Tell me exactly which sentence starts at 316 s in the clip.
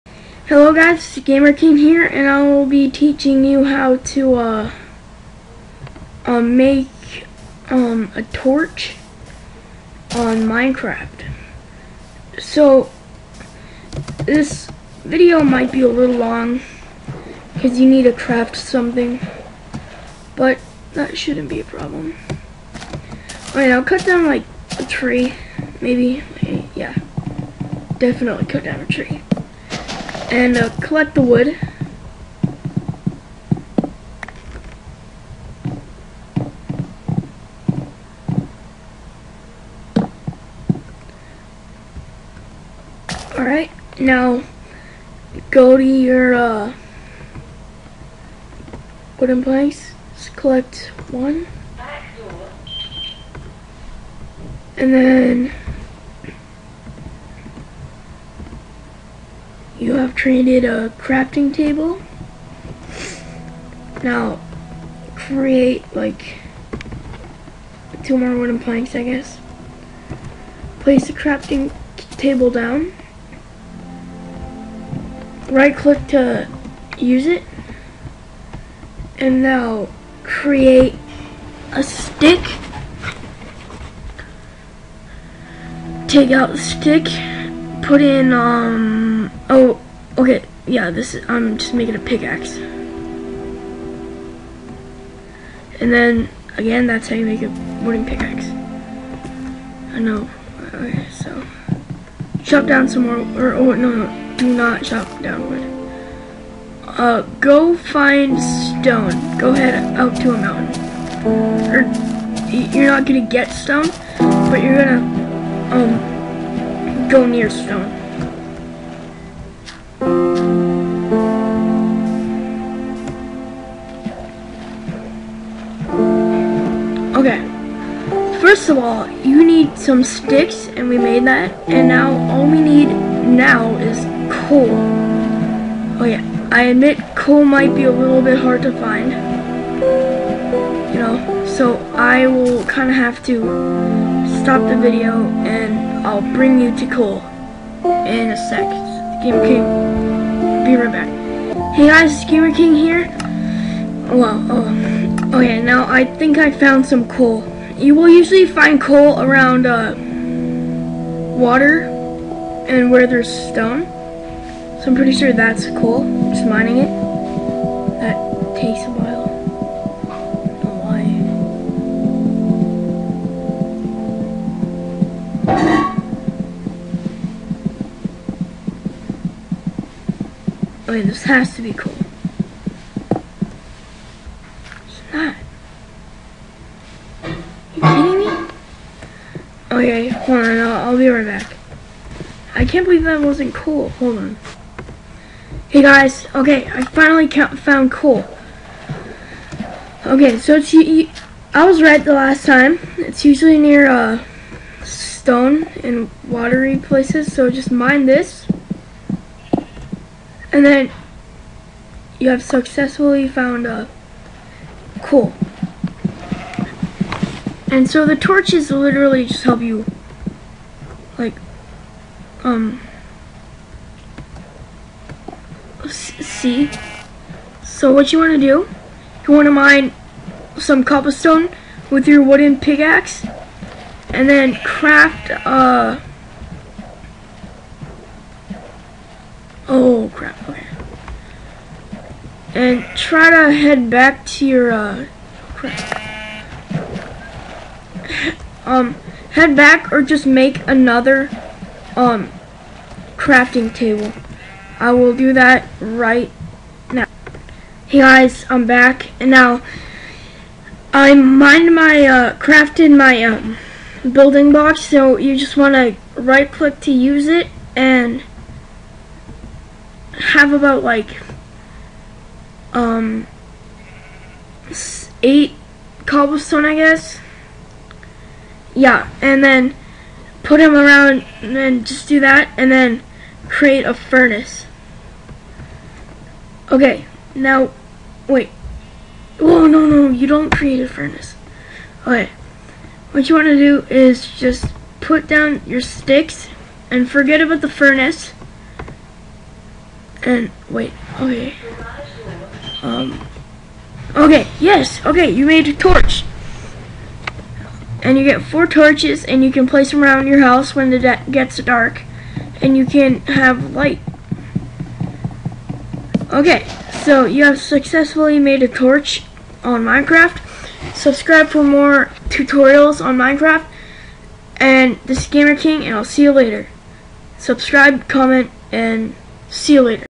Okay, so you have successfully made a torch on Minecraft.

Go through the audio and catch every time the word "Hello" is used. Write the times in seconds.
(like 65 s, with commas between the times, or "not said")
0 s.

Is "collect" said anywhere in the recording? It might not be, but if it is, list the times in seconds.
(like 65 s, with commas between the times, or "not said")
30 s, 50 s.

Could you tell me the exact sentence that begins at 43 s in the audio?
Alright, now go to your uh, wooden place.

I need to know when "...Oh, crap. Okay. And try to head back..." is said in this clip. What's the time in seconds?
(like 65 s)
239 s.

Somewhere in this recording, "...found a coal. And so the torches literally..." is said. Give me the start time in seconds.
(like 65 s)
213 s.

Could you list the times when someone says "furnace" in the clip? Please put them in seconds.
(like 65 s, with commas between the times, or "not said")
283 s, 290 s, 297 s.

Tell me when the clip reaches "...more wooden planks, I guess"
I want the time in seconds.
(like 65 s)
68 s.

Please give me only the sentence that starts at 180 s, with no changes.
Okay, this has to be coal.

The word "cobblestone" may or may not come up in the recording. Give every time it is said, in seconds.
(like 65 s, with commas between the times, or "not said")
230 s, 276 s.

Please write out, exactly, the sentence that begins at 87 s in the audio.
Put in, um, oh, Okay, yeah, this is, I'm just making a pickaxe.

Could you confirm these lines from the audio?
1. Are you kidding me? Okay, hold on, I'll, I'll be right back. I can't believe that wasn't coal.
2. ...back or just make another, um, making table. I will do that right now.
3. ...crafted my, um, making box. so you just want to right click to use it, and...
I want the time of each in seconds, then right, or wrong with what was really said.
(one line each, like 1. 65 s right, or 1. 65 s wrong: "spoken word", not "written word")
1. 187 s right
2. 249 s wrong: "crafting", not "making"
3. 262 s wrong: "building", not "making".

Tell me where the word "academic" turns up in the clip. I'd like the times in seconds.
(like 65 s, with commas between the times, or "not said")
not said.